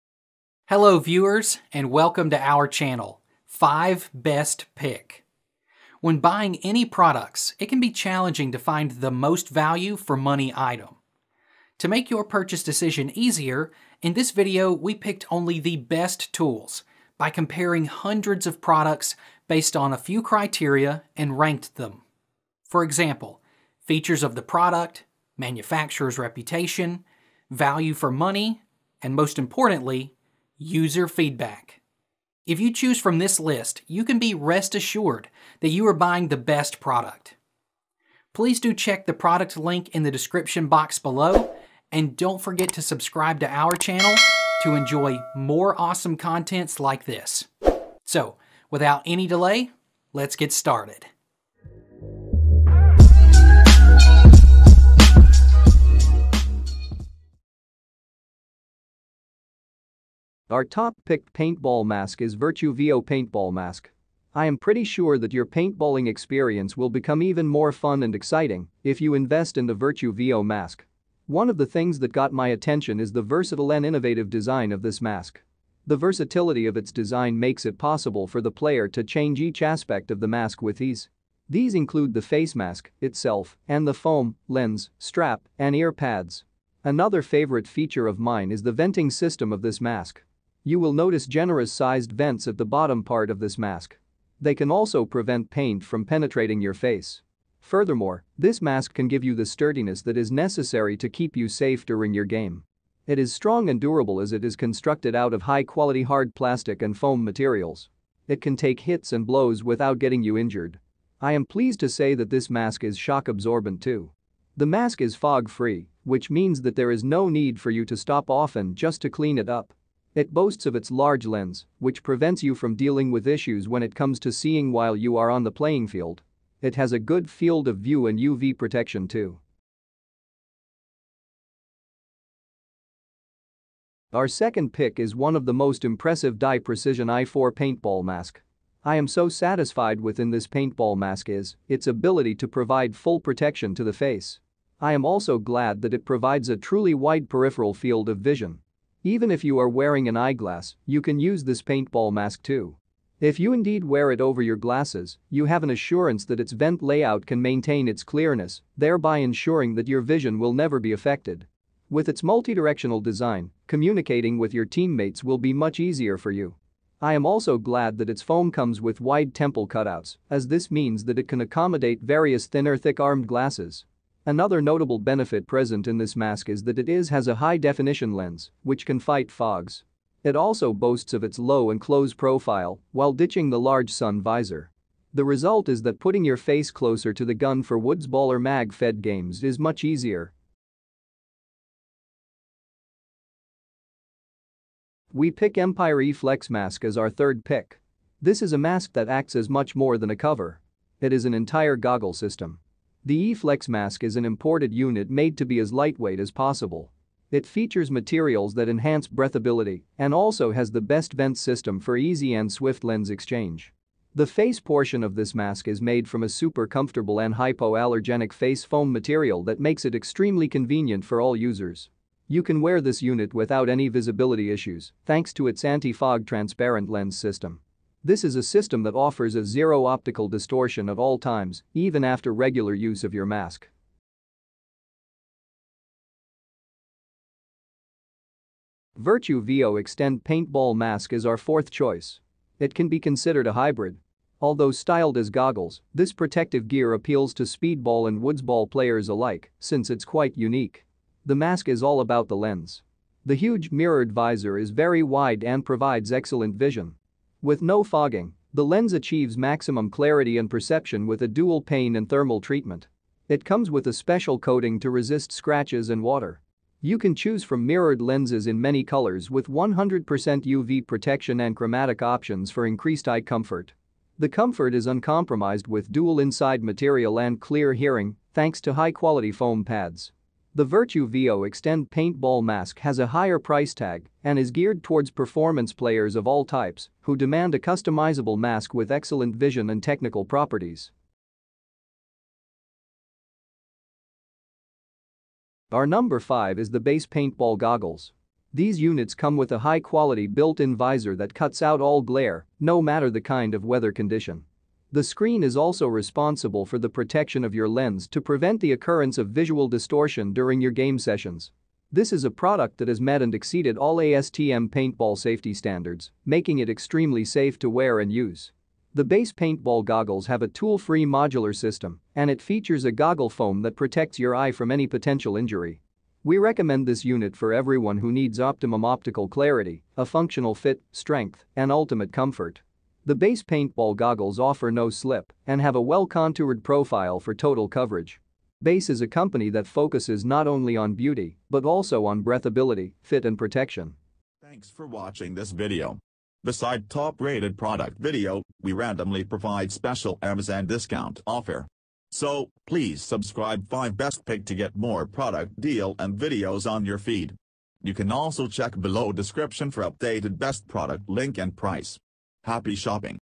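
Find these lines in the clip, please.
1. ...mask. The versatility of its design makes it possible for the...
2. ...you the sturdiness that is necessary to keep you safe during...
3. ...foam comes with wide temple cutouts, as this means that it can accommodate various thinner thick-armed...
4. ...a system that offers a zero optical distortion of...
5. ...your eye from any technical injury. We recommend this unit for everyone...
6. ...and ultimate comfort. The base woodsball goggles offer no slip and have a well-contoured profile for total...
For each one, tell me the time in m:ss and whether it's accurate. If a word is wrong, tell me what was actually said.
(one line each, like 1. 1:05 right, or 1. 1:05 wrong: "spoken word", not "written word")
1. 1:15 right
2. 1:39 right
3. 2:48 right
4. 3:48 right
5. 5:24 wrong: "potential", not "technical"
6. 5:31 wrong: "paintball", not "woodsball".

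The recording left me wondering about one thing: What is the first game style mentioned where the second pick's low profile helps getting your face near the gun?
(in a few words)
Woods Ball.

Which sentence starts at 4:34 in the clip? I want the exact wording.
The comfort is uncompromised with dual inside material and clear hearing thanks to high-quality foam pads.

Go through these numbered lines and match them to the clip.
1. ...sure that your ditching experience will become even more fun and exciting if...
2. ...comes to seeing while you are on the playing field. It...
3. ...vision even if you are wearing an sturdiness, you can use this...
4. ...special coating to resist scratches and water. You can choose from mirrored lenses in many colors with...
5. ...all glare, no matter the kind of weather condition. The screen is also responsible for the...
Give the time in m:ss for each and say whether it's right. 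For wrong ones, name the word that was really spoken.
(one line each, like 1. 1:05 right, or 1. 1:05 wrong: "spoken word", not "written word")
1. 1:04 wrong: "paintballing", not "ditching"
2. 2:03 right
3. 2:28 wrong: "eyeglass", not "sturdiness"
4. 4:23 right
5. 5:01 right.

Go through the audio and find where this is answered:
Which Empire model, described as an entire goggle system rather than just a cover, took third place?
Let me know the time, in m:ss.
3:15.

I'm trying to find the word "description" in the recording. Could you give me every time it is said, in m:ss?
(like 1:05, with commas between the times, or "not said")
0:40, 5:59.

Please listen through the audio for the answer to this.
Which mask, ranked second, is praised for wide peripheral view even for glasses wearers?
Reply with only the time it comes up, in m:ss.
2:16.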